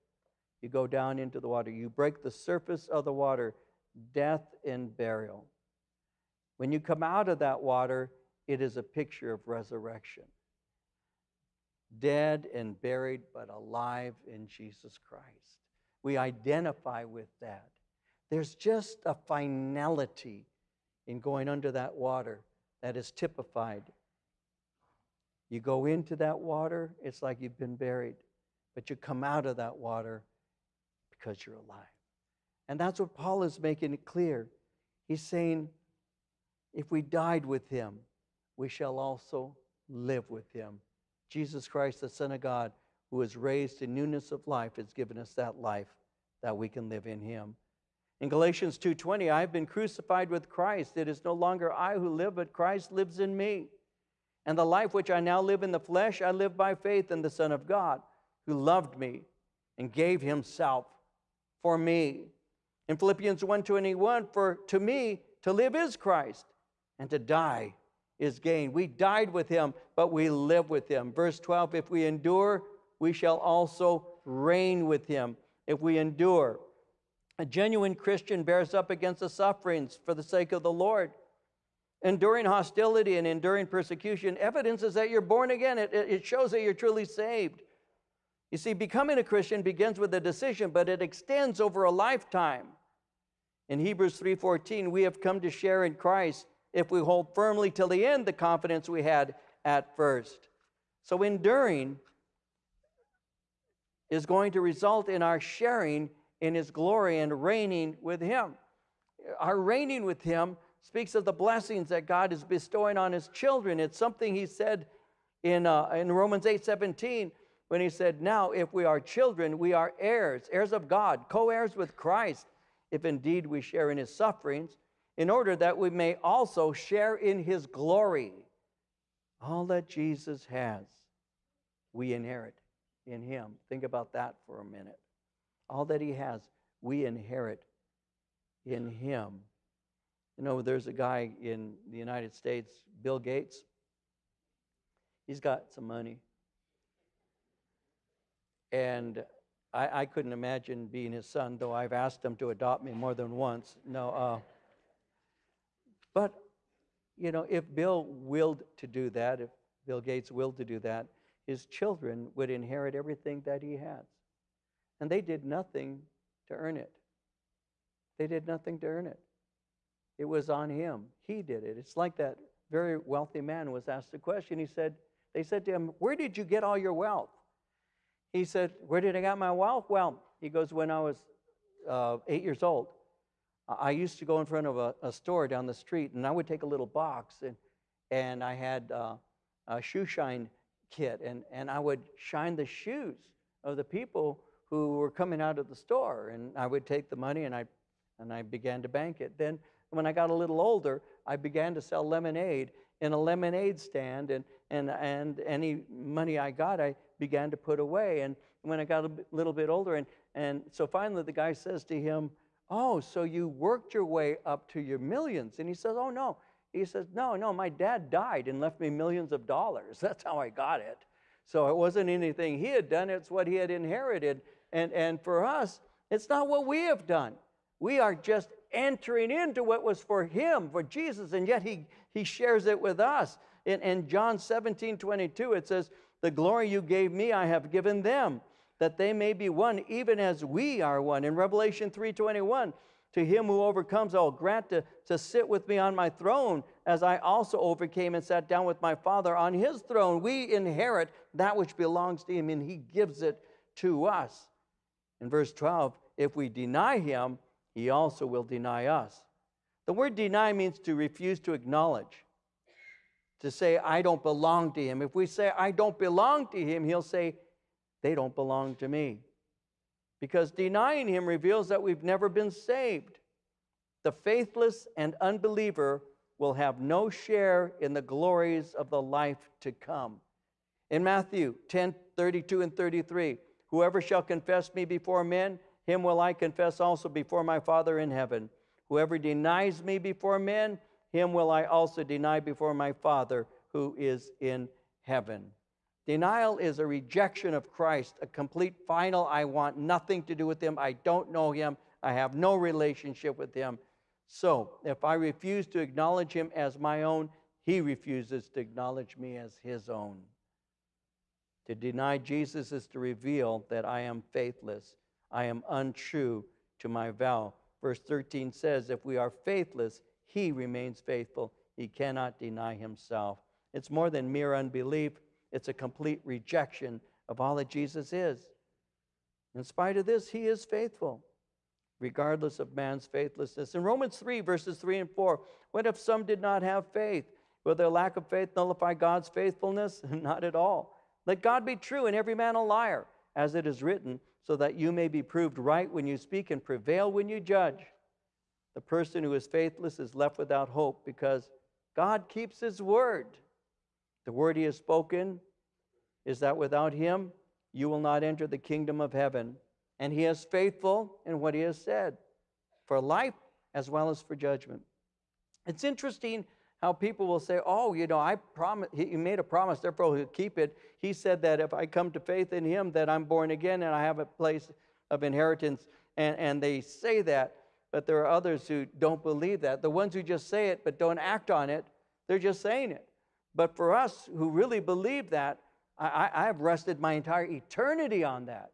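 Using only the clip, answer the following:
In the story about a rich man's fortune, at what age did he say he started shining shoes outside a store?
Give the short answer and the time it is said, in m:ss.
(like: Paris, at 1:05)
8, at 3:02.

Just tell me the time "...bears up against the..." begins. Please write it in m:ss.
1:18.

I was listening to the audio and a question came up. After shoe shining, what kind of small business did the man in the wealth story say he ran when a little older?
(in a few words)
lemonade stand.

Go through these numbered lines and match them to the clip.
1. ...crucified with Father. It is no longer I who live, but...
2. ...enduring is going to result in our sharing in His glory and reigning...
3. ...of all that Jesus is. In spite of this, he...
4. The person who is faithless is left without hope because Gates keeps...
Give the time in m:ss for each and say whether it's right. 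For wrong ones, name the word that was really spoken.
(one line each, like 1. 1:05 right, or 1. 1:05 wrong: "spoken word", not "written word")
1. 0:49 wrong: "Christ", not "Father"
2. 1:41 right
3. 5:27 right
4. 5:48 wrong: "God", not "Gates".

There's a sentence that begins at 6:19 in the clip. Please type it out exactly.
The ones who just say it but don't act on it, they're just saying it.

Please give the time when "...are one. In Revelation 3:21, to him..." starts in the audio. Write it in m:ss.
4:00.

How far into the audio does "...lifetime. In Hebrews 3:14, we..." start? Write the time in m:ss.
1:31.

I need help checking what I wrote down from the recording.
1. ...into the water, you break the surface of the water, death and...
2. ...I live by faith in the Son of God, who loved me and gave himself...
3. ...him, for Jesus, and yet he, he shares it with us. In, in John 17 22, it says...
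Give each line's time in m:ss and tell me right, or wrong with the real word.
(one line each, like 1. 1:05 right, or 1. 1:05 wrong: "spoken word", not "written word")
1. 0:01 right
2. 0:56 right
3. 3:50 right.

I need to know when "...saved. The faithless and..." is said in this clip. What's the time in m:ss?
4:32.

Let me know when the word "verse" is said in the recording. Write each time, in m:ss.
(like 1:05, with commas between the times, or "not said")
1:11, 4:15, 5:17, 5:34.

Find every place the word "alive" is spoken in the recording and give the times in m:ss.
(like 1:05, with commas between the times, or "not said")
0:13, 0:31.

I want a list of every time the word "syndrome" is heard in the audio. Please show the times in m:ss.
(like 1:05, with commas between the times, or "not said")
not said.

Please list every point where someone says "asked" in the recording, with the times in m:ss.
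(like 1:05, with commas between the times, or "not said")
2:31, 2:53.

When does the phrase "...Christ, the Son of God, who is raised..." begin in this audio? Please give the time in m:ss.
0:41.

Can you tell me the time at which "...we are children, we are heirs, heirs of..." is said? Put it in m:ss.
1:58.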